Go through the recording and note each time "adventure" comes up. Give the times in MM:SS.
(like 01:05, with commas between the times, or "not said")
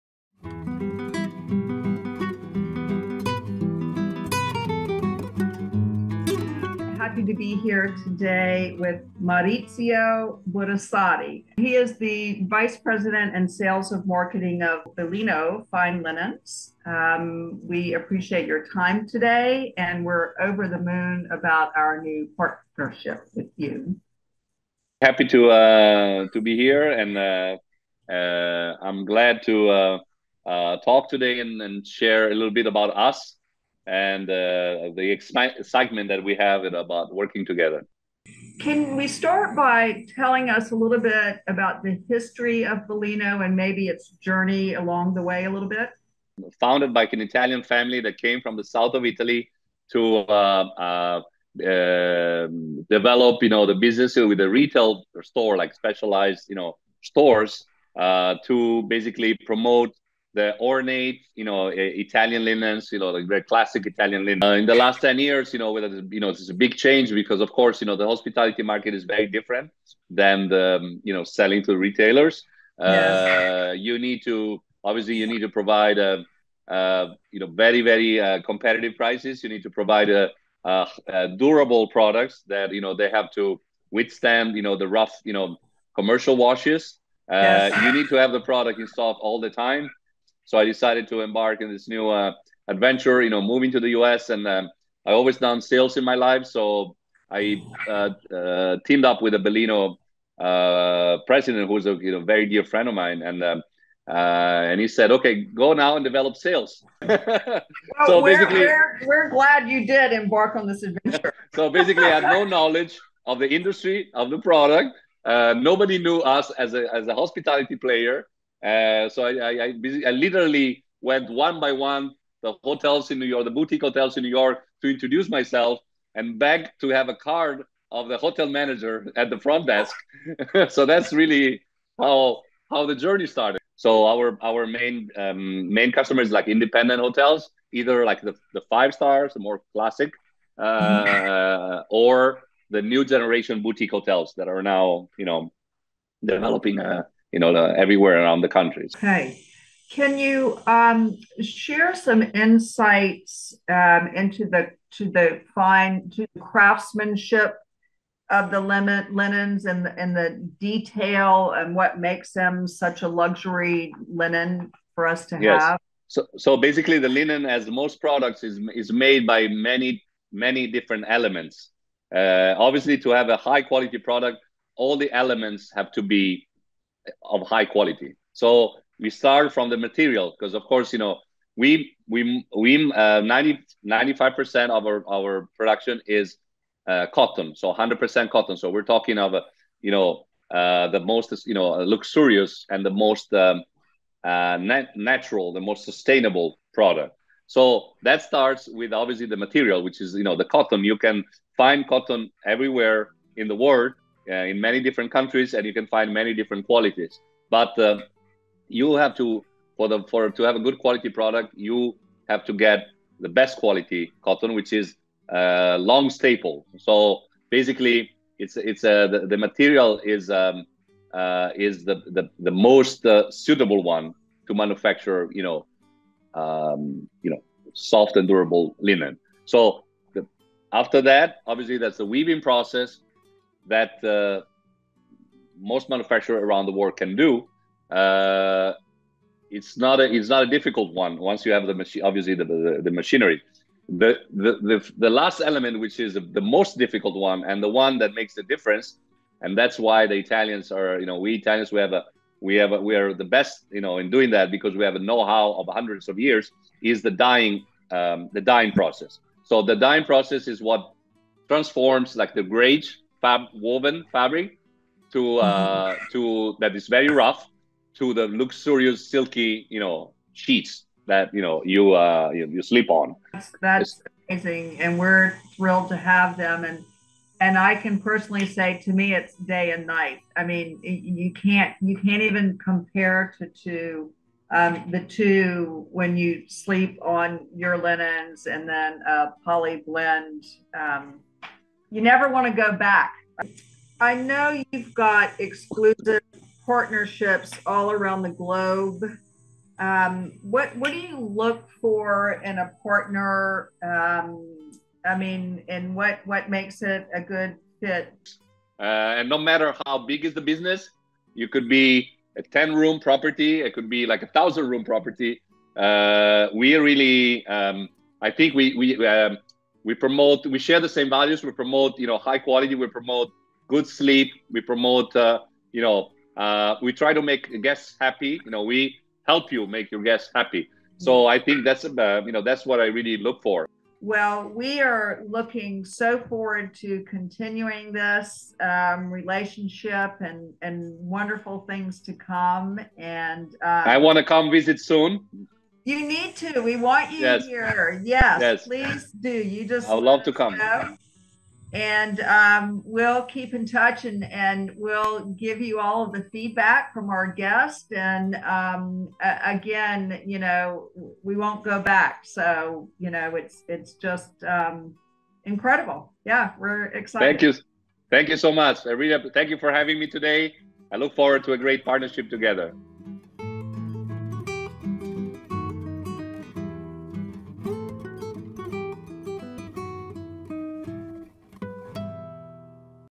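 01:32, 01:50.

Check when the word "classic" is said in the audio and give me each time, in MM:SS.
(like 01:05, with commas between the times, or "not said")
01:03, 02:19.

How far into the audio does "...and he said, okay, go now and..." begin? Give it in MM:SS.
01:44.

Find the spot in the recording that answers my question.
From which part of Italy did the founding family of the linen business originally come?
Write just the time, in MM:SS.
00:48.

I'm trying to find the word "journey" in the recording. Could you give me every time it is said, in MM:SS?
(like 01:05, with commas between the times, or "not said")
00:44, 02:12.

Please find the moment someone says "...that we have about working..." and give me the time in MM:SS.
00:36.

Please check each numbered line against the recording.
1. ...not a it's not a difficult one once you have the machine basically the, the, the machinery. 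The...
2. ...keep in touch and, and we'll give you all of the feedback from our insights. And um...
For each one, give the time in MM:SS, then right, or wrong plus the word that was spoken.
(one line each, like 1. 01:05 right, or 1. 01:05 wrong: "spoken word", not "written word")
1. 03:59 wrong: "obviously", not "basically"
2. 05:53 wrong: "guests", not "insights".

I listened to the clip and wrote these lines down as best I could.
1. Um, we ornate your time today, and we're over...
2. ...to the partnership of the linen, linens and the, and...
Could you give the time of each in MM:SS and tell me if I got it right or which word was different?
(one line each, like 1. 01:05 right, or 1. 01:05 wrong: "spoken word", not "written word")
1. 00:16 wrong: "appreciate", not "ornate"
2. 02:36 wrong: "craftsmanship", not "partnership".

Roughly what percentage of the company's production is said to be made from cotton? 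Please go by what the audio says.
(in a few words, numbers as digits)
95%.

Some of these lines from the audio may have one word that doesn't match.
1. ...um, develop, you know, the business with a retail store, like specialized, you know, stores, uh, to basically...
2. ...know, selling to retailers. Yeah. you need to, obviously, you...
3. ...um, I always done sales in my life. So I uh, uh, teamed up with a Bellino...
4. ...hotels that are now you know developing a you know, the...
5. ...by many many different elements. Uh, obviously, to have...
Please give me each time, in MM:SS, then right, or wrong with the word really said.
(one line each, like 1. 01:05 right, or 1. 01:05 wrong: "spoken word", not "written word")
1. 00:51 right
2. 01:11 right
3. 01:34 right
4. 02:23 right
5. 02:49 right.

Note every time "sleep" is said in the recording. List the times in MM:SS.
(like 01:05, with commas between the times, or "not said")
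04:32, 04:46, 05:23.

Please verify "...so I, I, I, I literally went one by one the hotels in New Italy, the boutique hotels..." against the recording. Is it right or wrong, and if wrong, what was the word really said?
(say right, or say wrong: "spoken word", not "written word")
wrong: "York", not "Italy".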